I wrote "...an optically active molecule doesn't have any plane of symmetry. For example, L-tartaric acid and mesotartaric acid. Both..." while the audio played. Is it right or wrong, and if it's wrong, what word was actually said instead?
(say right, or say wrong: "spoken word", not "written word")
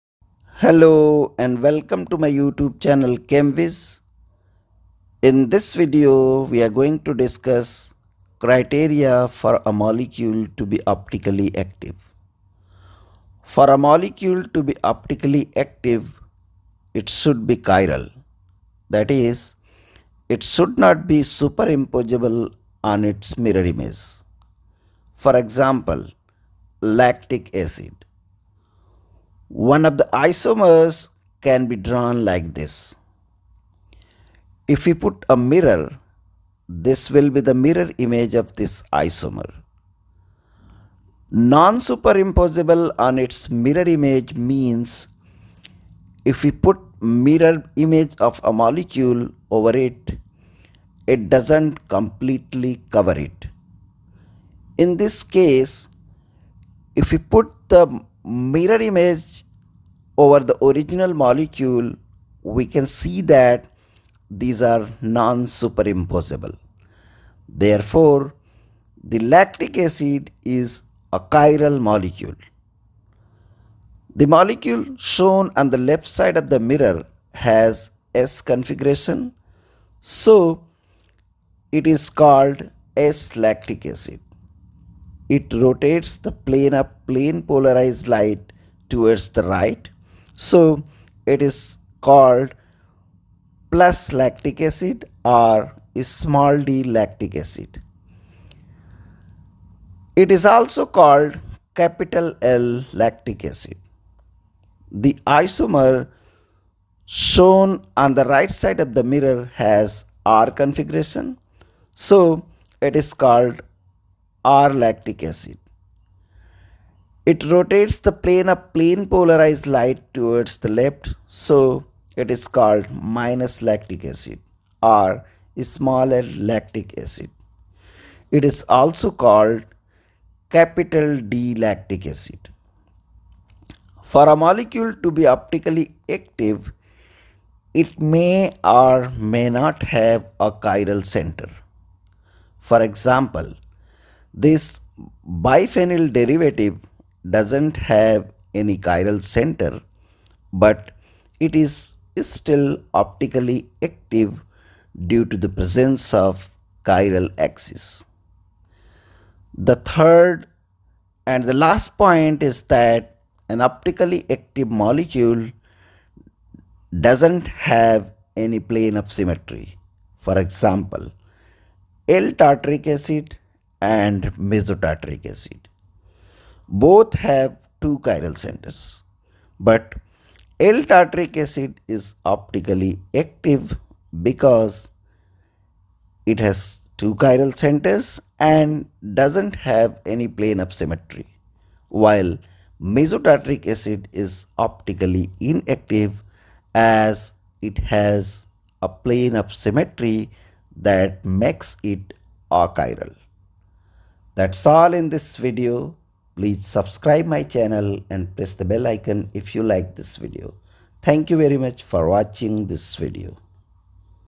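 right.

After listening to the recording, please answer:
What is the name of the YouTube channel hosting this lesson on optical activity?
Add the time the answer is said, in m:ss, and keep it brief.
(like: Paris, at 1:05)
ChemWis, at 0:03.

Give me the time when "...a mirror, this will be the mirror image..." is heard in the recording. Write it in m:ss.
0:35.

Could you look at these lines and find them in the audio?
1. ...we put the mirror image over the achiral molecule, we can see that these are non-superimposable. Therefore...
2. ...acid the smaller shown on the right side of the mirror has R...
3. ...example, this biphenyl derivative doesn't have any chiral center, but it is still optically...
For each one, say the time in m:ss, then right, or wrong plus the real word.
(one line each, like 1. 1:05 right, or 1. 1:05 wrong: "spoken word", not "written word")
1. 0:57 wrong: "original", not "achiral"
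2. 1:43 wrong: "isomer", not "smaller"
3. 2:22 right.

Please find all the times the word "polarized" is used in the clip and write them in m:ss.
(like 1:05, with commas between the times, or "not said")
1:27, 1:59.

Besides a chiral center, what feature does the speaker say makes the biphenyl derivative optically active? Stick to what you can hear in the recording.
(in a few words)
Chiral axis.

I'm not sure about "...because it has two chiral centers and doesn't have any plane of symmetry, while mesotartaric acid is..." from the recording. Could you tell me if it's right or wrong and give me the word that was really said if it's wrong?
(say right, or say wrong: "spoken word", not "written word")
right.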